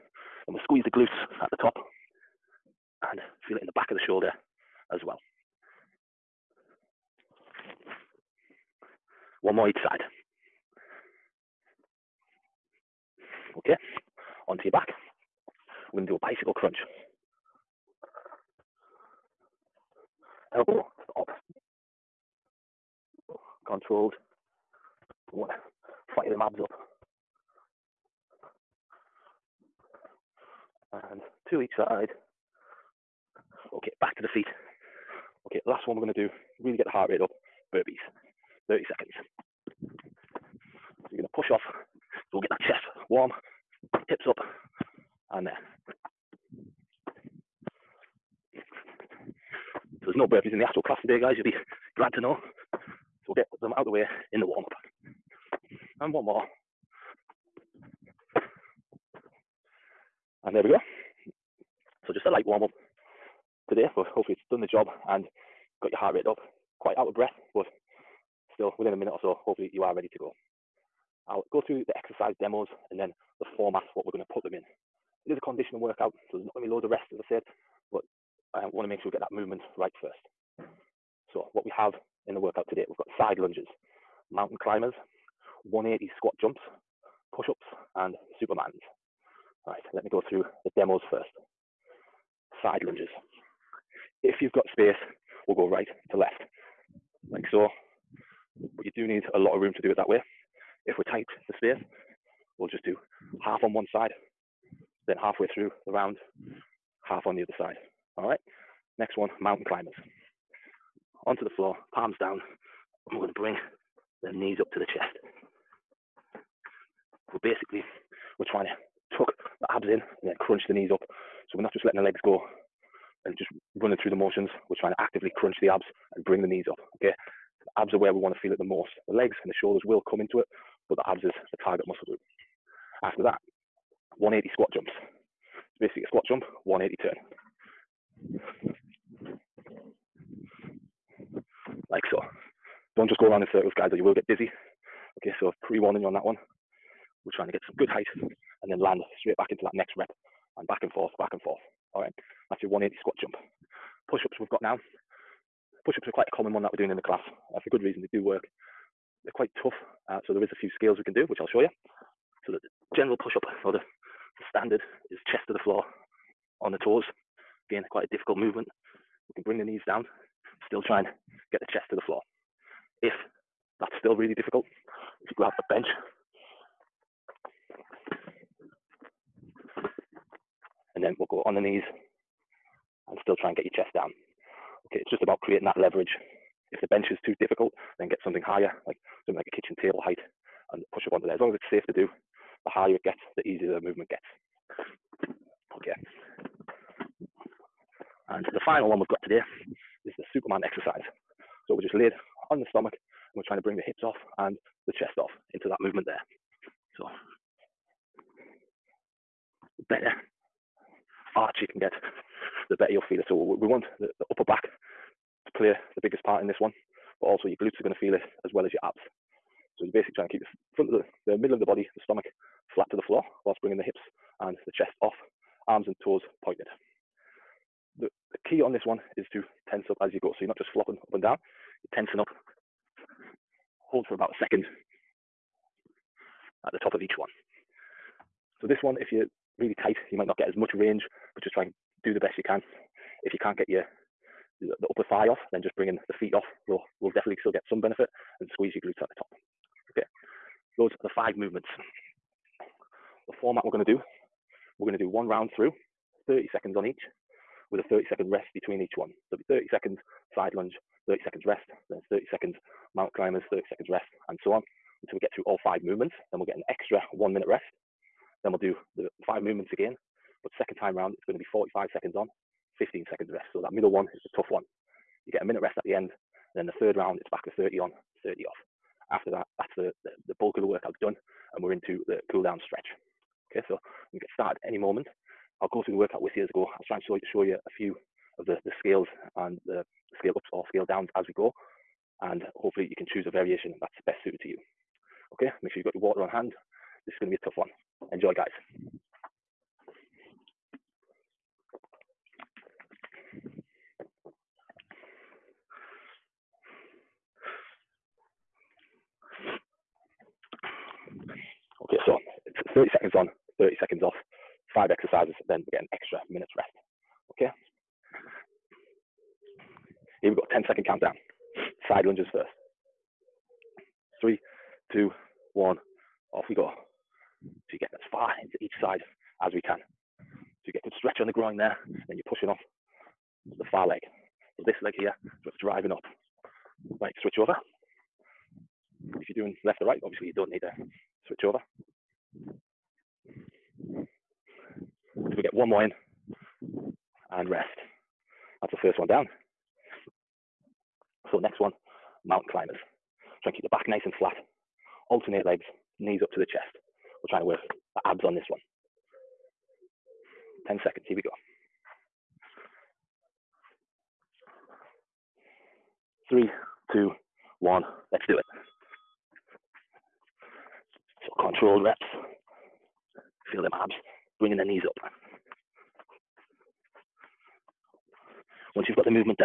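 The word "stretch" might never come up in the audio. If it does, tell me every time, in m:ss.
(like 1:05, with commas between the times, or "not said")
4:42, 5:30.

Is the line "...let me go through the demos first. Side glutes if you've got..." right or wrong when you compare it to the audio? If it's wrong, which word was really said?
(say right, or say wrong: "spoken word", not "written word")
wrong: "lunges", not "glutes".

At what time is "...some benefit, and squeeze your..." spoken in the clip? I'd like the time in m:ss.
4:07.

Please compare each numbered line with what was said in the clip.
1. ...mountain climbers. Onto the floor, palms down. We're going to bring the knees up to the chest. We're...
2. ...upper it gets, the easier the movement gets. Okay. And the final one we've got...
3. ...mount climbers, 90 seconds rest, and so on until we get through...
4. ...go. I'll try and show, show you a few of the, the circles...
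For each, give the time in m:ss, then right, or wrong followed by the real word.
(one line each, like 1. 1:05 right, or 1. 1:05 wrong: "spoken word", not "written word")
1. 1:49 right
2. 3:12 wrong: "higher", not "upper"
3. 4:22 wrong: "30", not "90"
4. 4:46 wrong: "scales", not "circles".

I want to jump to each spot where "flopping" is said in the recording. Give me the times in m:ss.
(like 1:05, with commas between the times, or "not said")
3:50.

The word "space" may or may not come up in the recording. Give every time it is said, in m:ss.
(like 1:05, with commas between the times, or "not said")
1:34, 1:41.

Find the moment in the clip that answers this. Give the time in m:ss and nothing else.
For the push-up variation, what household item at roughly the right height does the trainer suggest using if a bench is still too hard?
3:09.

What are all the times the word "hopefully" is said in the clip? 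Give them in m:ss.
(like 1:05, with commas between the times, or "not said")
1:04, 1:09, 4:52.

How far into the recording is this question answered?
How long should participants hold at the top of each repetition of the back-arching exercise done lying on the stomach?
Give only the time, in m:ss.
3:54.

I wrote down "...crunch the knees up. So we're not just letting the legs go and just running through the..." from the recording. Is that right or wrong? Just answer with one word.
right.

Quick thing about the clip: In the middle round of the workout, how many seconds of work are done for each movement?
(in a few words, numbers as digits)
45.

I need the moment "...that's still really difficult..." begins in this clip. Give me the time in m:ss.
2:53.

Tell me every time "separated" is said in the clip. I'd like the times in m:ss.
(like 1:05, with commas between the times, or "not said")
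not said.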